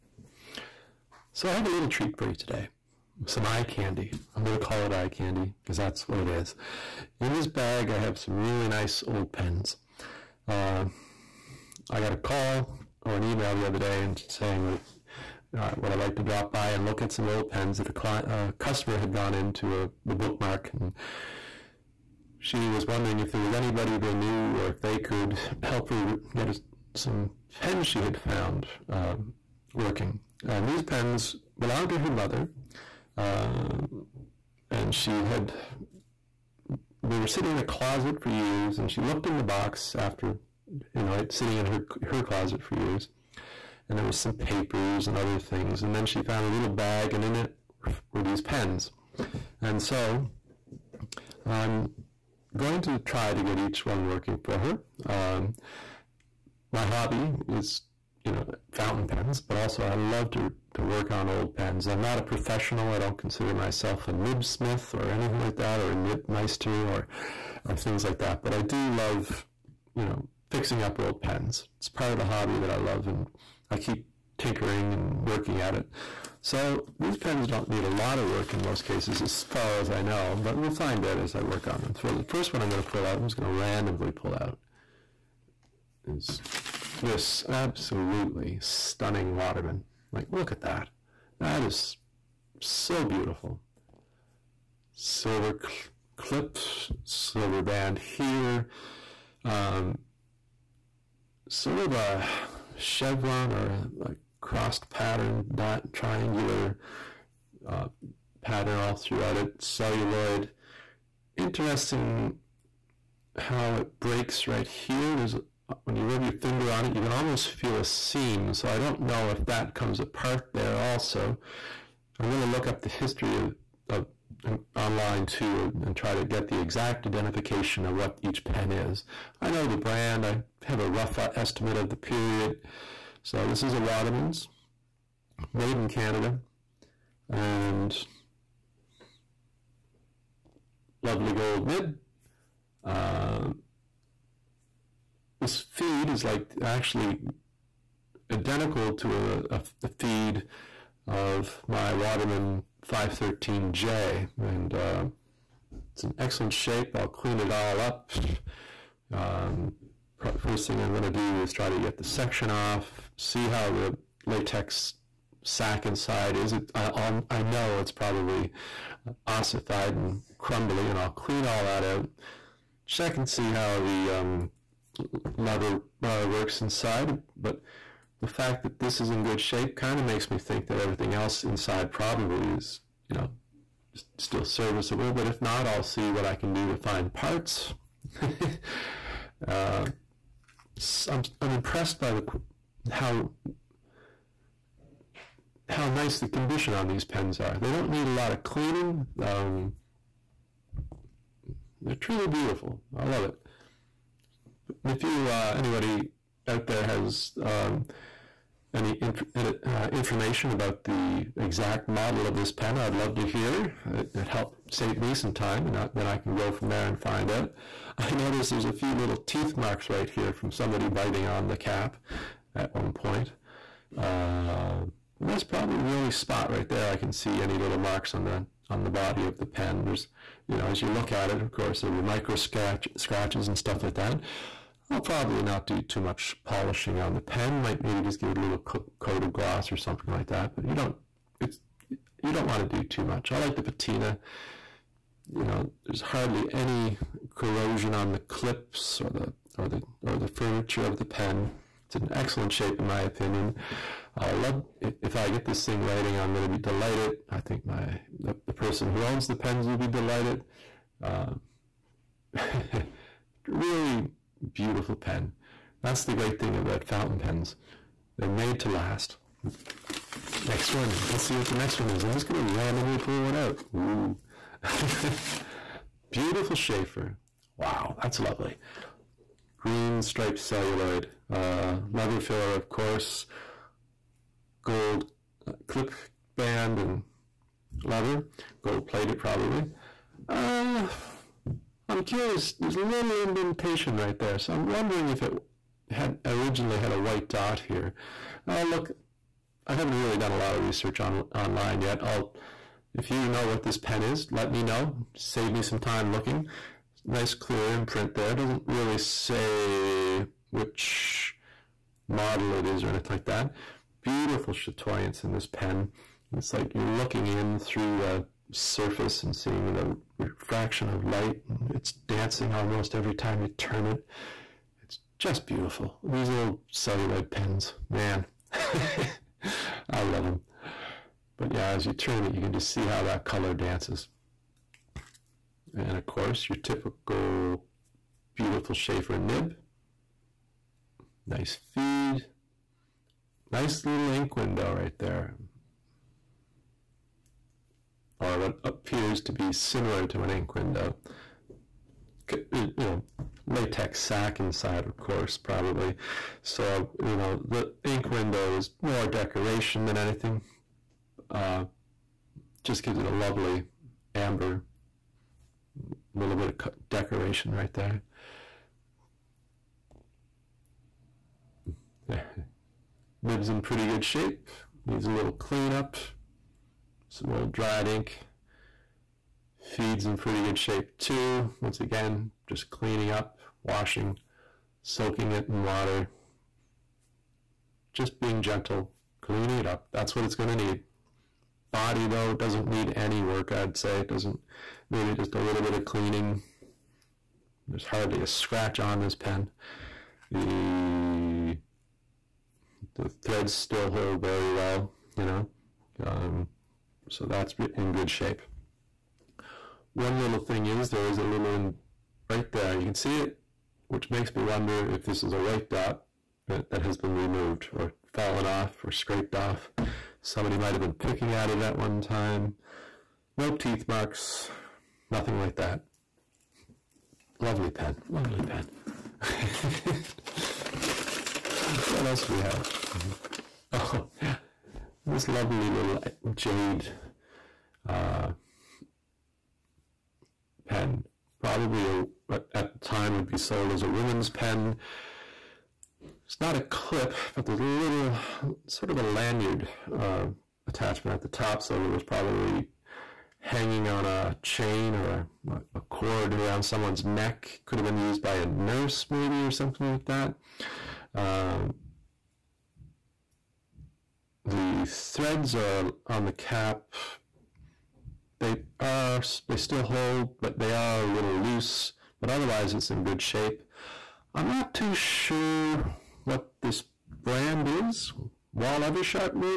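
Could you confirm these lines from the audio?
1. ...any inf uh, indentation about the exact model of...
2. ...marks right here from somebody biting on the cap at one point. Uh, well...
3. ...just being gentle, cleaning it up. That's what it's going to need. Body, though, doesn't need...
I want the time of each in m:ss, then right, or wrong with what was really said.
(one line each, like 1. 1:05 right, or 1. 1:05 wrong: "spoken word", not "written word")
1. 3:28 wrong: "information", not "indentation"
2. 3:39 right
3. 6:27 right.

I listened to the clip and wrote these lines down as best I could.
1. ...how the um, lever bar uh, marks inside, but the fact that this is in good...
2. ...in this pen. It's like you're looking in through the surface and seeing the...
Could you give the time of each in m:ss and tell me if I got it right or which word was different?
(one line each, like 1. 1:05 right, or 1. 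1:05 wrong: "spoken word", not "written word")
1. 2:53 wrong: "works", not "marks"
2. 5:15 right.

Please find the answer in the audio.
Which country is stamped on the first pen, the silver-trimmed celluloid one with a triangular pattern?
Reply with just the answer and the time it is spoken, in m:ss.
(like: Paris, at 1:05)
Canada, at 2:15.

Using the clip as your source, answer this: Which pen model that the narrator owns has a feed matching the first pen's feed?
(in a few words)
513J.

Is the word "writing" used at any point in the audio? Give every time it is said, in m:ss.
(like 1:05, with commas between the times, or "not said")
4:15.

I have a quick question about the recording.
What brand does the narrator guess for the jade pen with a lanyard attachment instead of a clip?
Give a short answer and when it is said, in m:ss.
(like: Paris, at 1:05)
Wahl Eversharp, at 7:58.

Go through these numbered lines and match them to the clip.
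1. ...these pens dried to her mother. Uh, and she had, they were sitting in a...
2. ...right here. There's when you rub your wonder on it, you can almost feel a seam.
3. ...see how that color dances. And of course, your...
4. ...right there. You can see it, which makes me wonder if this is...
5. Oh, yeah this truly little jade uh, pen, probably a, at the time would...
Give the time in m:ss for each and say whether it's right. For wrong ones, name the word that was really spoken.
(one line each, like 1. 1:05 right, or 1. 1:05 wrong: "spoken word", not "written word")
1. 0:30 wrong: "belonged", not "dried"
2. 1:54 wrong: "finger", not "wonder"
3. 5:32 right
4. 6:52 right
5. 7:13 wrong: "lovely", not "truly".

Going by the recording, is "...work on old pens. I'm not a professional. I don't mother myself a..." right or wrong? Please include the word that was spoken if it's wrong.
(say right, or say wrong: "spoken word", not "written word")
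wrong: "consider", not "mother".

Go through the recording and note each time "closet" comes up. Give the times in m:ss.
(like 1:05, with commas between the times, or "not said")
0:37, 0:42.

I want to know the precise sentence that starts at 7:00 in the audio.
Somebody might have been picking at it at one time.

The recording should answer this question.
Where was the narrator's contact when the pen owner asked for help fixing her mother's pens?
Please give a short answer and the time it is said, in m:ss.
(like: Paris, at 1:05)
the bookmark, at 0:20.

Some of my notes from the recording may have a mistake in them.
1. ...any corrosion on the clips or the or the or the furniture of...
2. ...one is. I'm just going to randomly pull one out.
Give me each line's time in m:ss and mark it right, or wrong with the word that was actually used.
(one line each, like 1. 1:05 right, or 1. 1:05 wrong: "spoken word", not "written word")
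1. 4:06 right
2. 4:31 right.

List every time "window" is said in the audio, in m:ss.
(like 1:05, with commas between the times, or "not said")
5:44, 5:50, 5:58.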